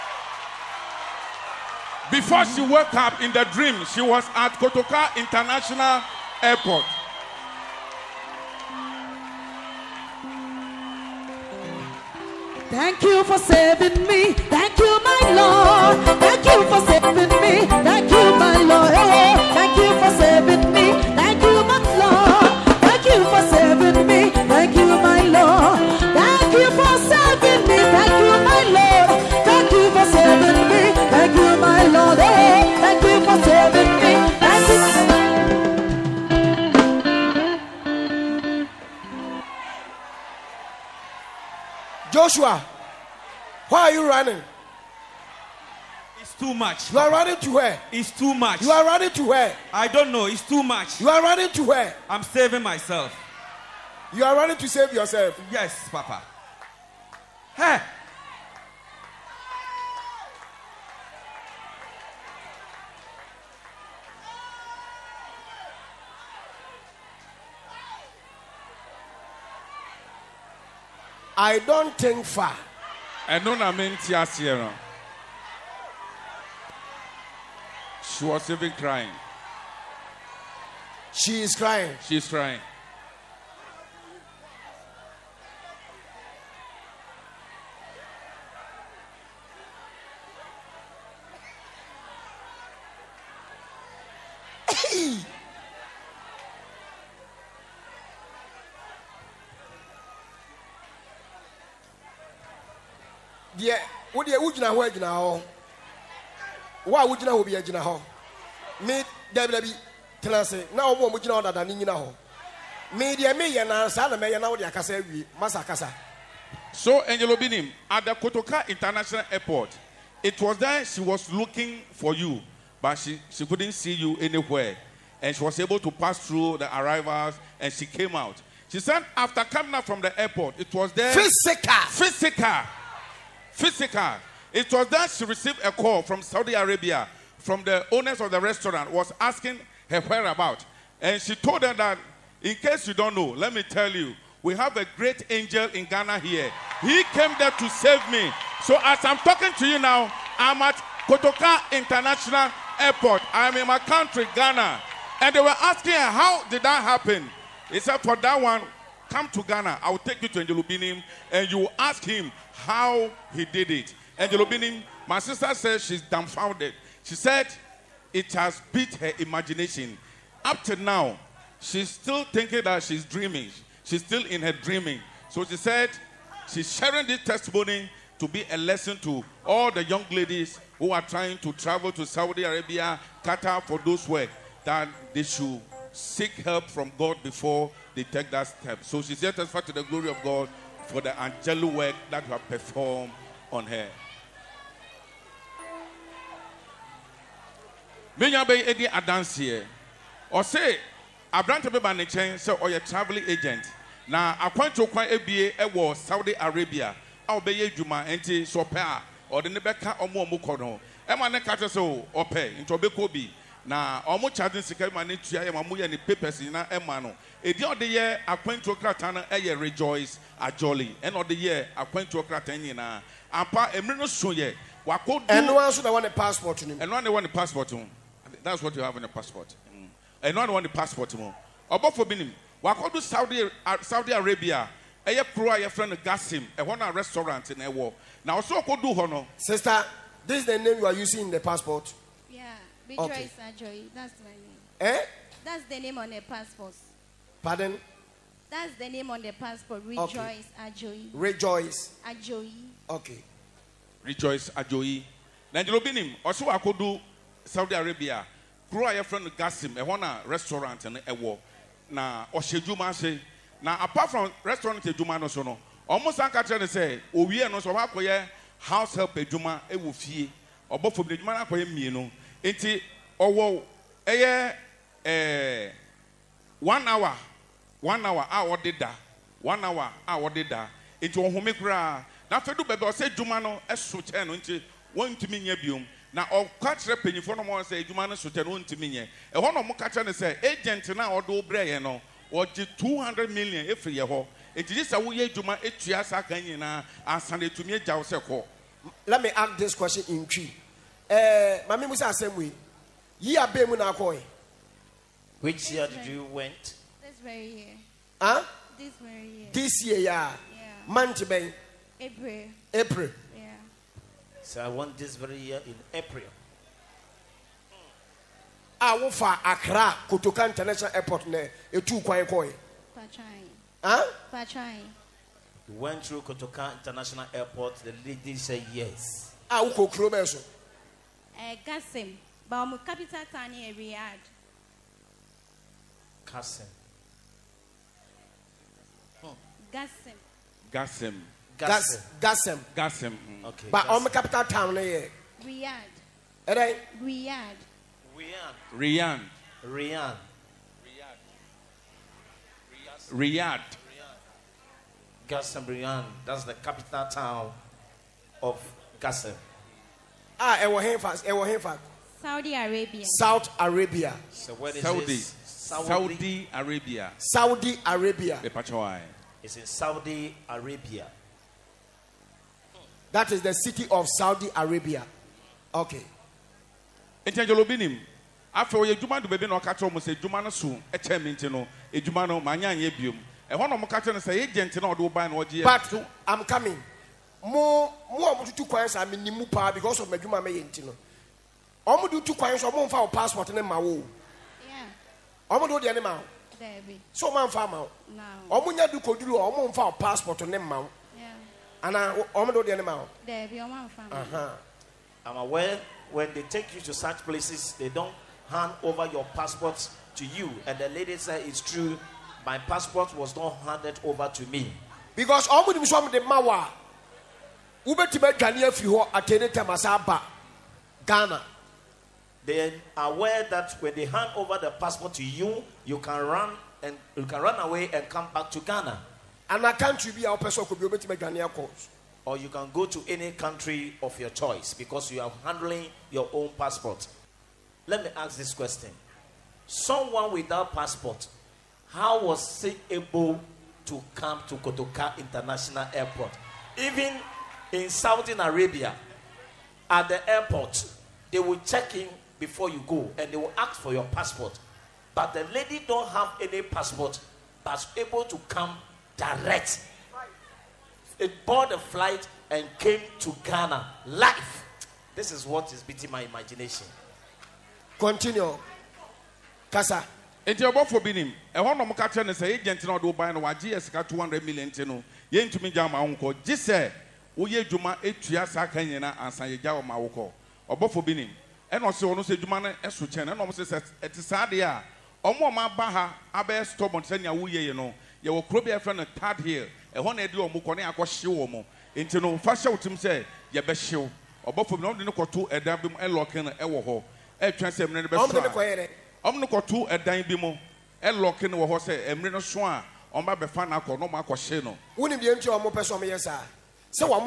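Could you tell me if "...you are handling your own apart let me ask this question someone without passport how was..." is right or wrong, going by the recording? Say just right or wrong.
wrong.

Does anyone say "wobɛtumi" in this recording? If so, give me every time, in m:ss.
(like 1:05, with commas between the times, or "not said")
6:57, 7:10.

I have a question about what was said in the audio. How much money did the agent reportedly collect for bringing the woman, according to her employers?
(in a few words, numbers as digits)
200 million.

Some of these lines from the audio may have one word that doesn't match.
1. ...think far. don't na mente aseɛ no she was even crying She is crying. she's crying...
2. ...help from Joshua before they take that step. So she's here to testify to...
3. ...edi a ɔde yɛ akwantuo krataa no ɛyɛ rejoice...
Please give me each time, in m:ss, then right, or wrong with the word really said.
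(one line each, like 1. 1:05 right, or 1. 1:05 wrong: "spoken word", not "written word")
1. 1:11 right
2. 3:06 wrong: "God", not "Joshua"
3. 3:37 right.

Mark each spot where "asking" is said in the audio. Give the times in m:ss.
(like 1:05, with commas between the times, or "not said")
2:19, 2:35.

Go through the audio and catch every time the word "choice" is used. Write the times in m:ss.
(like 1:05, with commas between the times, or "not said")
7:14.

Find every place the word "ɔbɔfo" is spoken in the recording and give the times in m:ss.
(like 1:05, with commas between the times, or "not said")
3:51, 4:30, 7:50, 8:00, 8:14.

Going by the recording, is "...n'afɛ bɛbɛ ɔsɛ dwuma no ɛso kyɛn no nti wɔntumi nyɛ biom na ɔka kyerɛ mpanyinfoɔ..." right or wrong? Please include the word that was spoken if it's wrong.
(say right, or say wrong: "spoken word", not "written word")
right.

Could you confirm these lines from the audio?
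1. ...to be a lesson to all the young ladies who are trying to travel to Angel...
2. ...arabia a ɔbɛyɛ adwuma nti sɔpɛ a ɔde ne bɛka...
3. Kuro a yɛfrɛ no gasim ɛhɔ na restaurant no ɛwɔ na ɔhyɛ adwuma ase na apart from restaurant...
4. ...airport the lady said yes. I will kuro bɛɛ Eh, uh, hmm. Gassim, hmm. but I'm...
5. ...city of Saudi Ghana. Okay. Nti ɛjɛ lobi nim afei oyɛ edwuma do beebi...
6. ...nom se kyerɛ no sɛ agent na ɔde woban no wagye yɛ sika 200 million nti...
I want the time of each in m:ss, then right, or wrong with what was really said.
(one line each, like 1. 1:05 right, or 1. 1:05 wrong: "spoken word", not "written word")
1. 2:58 wrong: "Saudi", not "Angel"
2. 3:26 right
3. 4:18 right
4. 5:27 right
5. 6:13 wrong: "Arabia", not "Ghana"
6. 7:51 right.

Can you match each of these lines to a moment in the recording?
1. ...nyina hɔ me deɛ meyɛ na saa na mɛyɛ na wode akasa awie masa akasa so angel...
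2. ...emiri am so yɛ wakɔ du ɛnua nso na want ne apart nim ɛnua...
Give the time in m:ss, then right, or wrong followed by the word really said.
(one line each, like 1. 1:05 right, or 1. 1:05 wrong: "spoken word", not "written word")
1. 1:51 right
2. 3:43 wrong: "passport", not "apart".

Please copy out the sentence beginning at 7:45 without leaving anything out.
This is what is beating my imagination.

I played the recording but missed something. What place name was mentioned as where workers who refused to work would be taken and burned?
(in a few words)
Third Hill.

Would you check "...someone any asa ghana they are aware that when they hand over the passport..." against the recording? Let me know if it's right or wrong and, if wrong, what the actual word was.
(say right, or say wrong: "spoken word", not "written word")
wrong: "atene", not "someone".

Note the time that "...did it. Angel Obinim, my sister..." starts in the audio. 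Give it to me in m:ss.
2:43.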